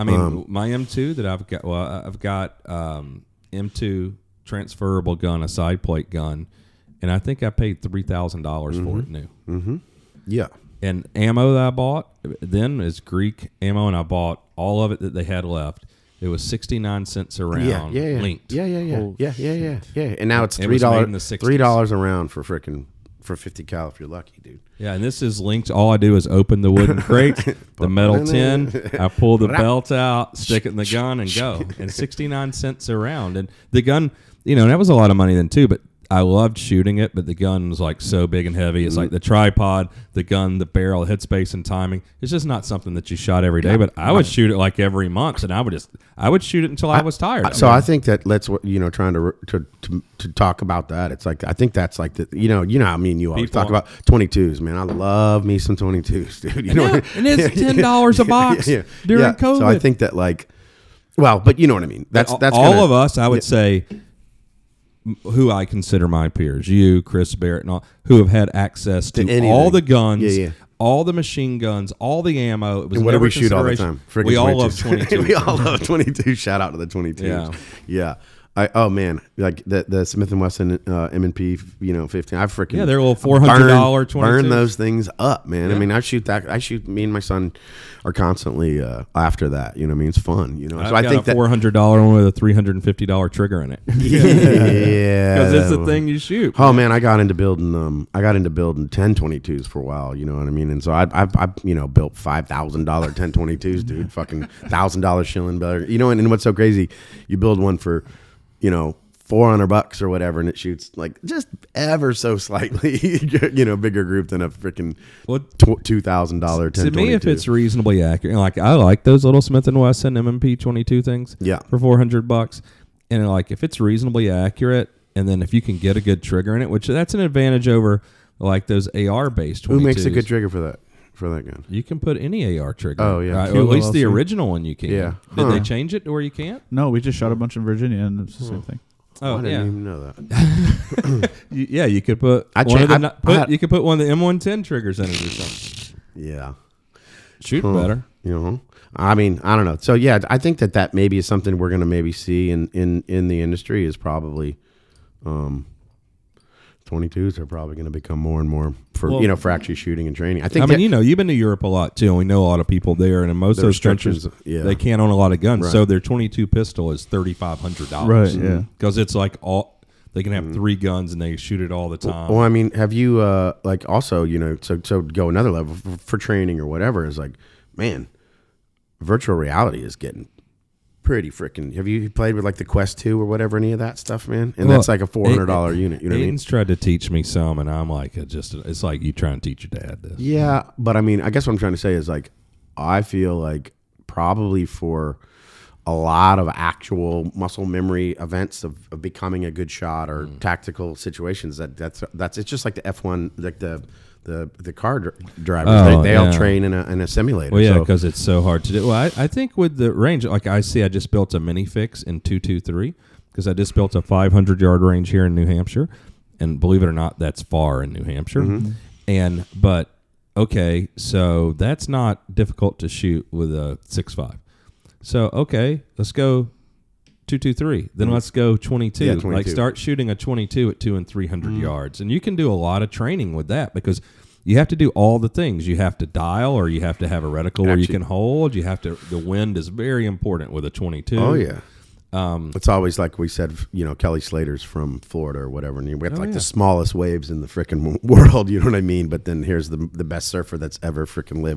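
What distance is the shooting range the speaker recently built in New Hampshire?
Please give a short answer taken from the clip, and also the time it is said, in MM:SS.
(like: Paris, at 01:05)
500 yards, at 03:34.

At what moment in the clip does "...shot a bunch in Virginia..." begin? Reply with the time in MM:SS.
02:17.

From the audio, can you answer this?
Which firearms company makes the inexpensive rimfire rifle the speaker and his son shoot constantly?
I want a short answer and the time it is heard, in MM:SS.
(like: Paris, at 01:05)
Smith and Wesson, at 01:20.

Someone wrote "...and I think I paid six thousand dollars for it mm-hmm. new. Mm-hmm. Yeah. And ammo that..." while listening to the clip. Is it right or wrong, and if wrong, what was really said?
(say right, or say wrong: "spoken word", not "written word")
wrong: "three", not "six".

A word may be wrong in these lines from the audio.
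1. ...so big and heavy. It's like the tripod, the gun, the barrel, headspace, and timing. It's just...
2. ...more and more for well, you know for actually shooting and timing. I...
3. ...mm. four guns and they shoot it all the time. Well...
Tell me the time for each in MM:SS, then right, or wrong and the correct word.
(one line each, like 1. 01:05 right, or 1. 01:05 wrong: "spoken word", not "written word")
1. 00:38 right
2. 02:38 wrong: "training", not "timing"
3. 02:50 wrong: "three", not "four".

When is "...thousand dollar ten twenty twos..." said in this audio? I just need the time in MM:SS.
01:42.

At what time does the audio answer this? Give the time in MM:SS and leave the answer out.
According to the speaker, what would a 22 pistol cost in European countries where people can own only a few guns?
02:47.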